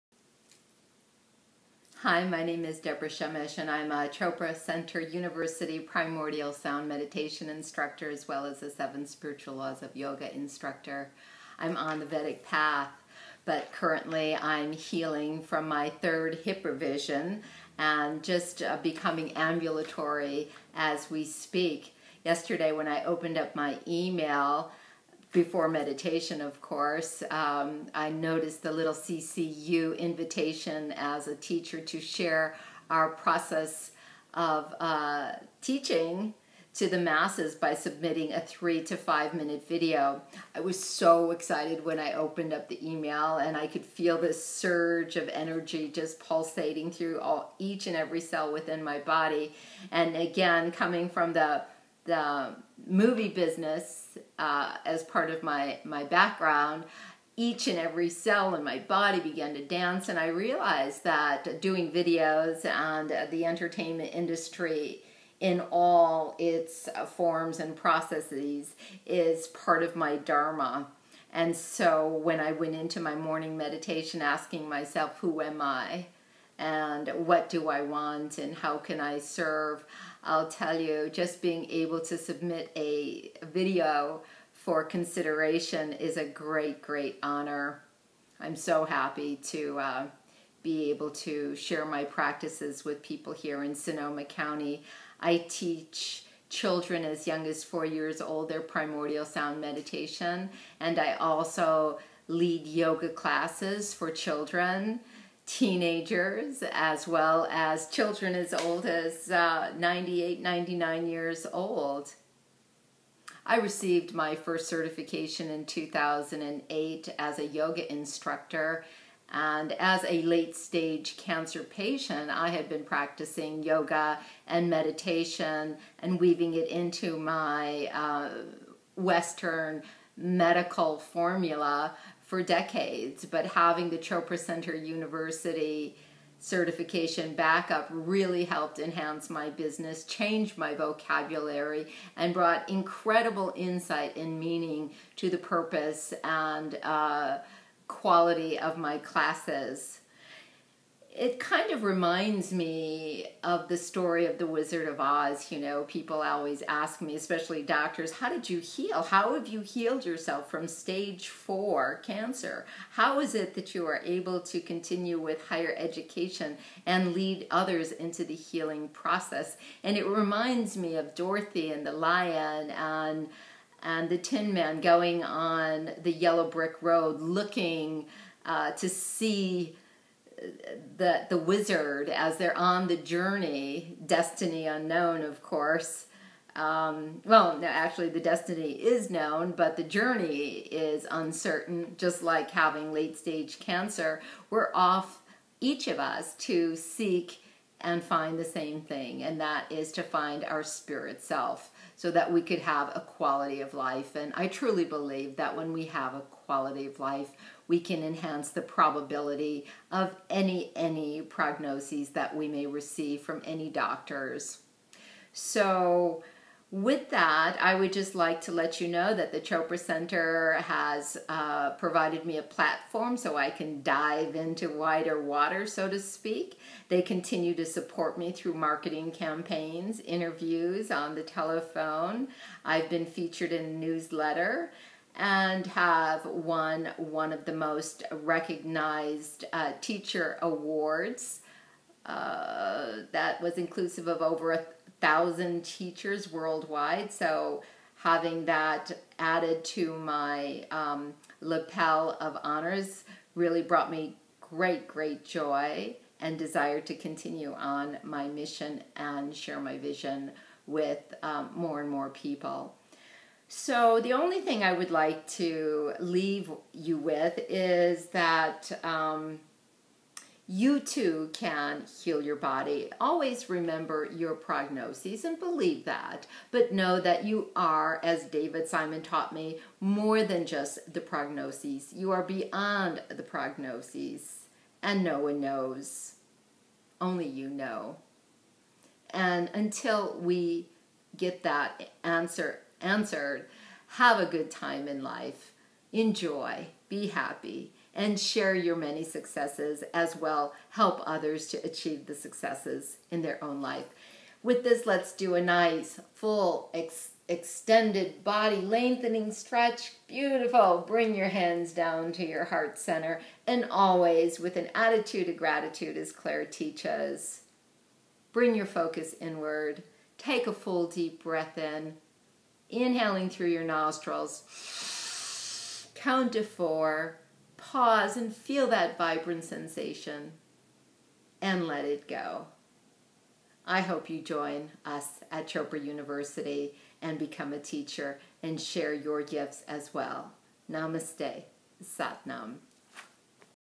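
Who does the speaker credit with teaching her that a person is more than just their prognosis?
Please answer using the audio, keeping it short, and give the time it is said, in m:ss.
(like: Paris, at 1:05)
David Simon, at 4:38.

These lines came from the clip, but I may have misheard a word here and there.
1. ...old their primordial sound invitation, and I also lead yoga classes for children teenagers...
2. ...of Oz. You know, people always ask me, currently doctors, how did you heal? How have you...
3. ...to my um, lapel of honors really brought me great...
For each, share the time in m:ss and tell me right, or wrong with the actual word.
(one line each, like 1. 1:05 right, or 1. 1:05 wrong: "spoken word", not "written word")
1. 1:38 wrong: "meditation", not "invitation"
2. 2:34 wrong: "especially", not "currently"
3. 4:09 right.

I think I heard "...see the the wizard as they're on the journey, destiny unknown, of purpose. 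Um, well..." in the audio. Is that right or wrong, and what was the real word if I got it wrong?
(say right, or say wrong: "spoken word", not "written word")
wrong: "course", not "purpose".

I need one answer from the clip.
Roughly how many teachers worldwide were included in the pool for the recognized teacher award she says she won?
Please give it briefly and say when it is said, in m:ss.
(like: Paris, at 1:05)
Over 1000, at 4:04.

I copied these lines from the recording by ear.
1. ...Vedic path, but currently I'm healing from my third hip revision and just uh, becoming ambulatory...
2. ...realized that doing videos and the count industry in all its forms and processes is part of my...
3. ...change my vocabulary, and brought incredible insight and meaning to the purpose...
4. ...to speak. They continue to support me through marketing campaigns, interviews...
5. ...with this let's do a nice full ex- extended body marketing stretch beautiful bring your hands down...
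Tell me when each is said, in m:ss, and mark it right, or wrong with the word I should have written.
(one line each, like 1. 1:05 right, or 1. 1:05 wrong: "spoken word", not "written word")
1. 0:12 right
2. 1:00 wrong: "entertainment", not "count"
3. 2:20 right
4. 3:45 right
5. 5:04 wrong: "lengthening", not "marketing".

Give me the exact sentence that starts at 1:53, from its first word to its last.
I received my first certification in 2008 as a yoga instructor.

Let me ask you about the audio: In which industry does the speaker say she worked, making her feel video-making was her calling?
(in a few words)
The movie business.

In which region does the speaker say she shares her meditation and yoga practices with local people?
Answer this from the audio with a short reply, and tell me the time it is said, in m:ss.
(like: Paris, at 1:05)
Sonoma County, at 1:33.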